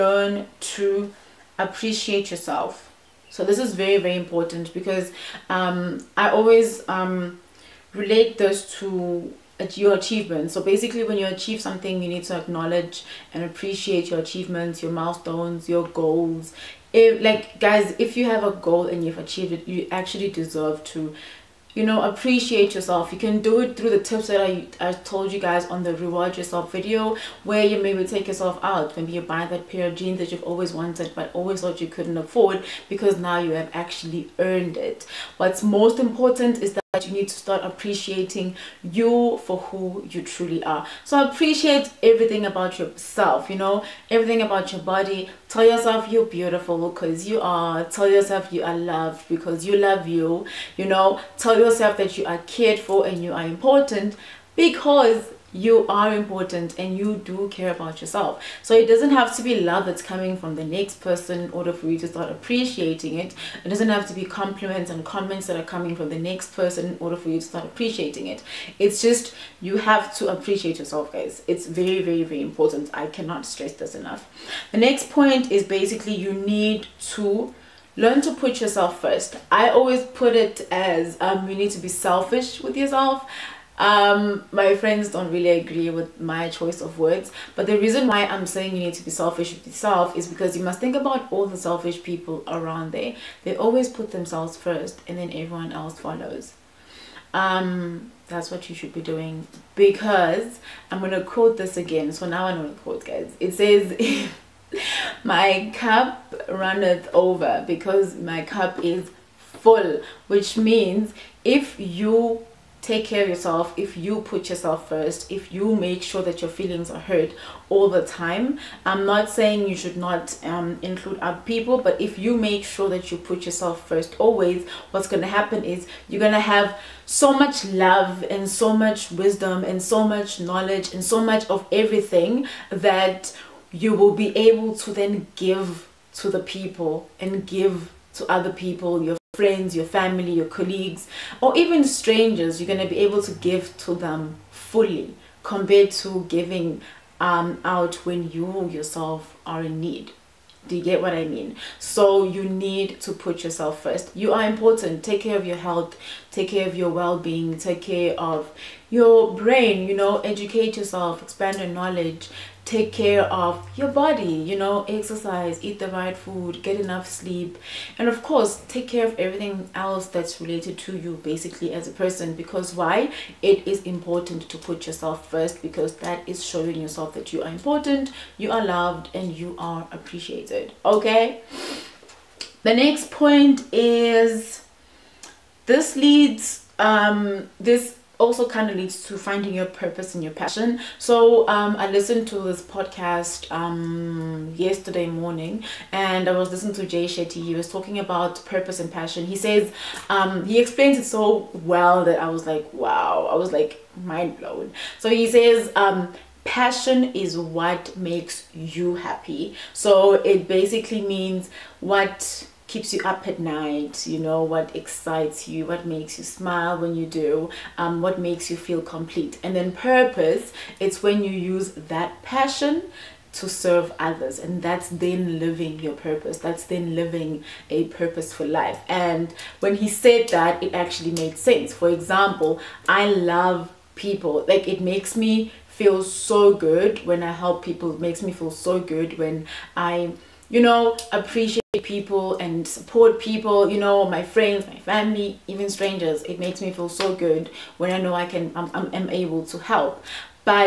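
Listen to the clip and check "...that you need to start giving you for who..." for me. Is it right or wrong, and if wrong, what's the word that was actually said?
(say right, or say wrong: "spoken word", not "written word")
wrong: "appreciating", not "giving".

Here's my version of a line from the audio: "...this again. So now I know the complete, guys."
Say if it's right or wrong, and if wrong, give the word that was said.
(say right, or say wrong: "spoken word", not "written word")
wrong: "quote", not "complete".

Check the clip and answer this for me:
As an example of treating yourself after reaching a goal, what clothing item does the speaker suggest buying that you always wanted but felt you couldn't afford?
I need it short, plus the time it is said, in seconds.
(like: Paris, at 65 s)
pair of jeans, at 29 s.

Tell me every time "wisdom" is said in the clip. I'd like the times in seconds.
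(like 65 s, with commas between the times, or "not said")
129 s.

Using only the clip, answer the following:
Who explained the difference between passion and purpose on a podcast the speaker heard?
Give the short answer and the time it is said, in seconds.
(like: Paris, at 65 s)
Jay Shetty, at 196 s.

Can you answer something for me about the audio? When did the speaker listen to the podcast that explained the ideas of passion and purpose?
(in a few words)
yesterday morning.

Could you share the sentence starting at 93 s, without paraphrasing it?
They always put themselves first and then everyone else follows.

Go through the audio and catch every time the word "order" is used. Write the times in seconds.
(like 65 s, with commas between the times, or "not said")
61 s, 67 s.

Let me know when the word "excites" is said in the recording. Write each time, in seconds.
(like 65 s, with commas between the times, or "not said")
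214 s.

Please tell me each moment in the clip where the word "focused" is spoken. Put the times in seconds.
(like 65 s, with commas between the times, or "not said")
not said.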